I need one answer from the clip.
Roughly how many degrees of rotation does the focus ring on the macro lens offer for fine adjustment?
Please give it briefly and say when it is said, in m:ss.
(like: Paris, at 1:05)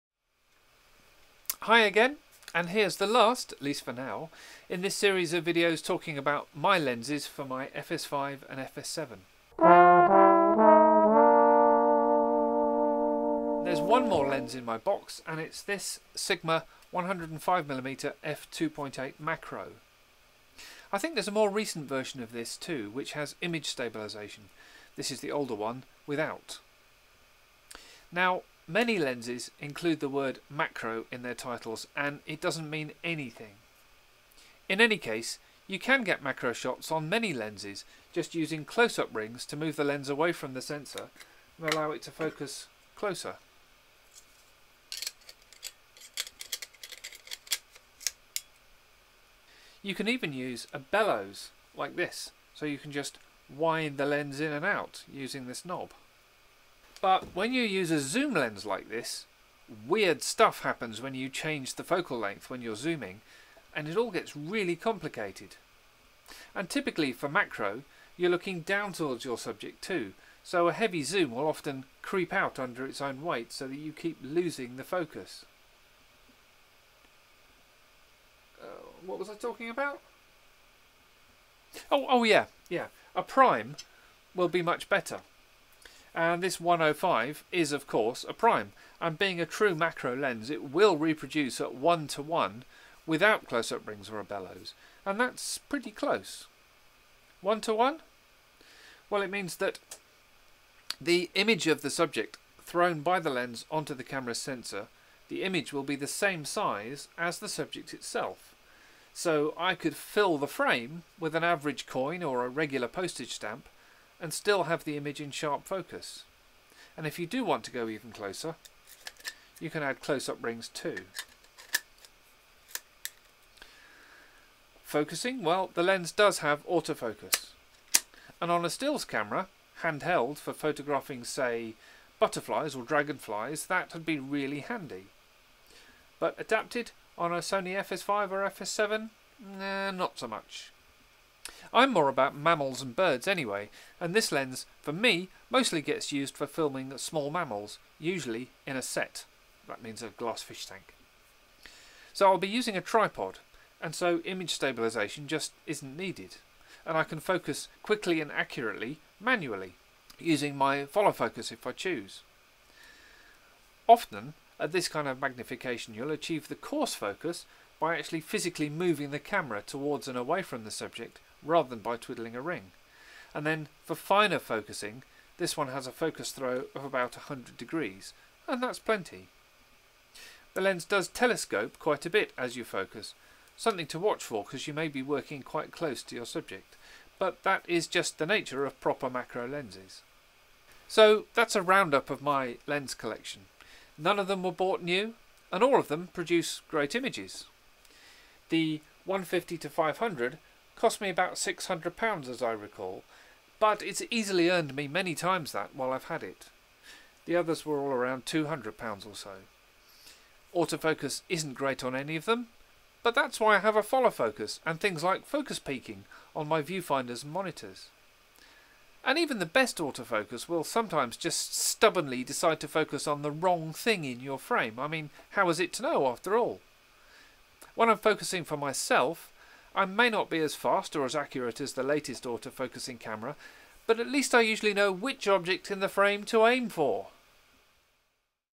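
100 degrees, at 2:57.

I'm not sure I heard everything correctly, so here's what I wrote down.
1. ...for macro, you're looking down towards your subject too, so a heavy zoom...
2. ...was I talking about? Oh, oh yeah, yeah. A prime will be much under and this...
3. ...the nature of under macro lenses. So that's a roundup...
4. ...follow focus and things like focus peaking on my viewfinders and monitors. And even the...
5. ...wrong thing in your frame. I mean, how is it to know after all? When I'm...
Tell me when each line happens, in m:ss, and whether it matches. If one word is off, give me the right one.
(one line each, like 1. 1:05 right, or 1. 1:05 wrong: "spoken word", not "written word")
1. 1:07 right
2. 1:19 wrong: "better", not "under"
3. 3:08 wrong: "proper", not "under"
4. 3:33 right
5. 3:43 right.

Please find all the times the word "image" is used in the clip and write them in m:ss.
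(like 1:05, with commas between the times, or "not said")
0:23, 1:41, 1:45, 1:54, 2:34, 3:16.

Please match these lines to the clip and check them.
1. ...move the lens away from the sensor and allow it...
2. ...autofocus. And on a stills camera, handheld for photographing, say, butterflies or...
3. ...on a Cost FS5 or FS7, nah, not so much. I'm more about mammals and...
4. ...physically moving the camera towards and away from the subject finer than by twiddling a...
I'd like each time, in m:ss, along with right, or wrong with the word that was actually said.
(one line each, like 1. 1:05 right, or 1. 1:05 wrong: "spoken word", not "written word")
1. 0:39 right
2. 2:06 right
3. 2:17 wrong: "Sony", not "Cost"
4. 2:48 wrong: "rather", not "finer".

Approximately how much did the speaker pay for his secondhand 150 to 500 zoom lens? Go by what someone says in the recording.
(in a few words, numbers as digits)
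£600.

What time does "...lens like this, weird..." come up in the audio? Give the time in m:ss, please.
0:58.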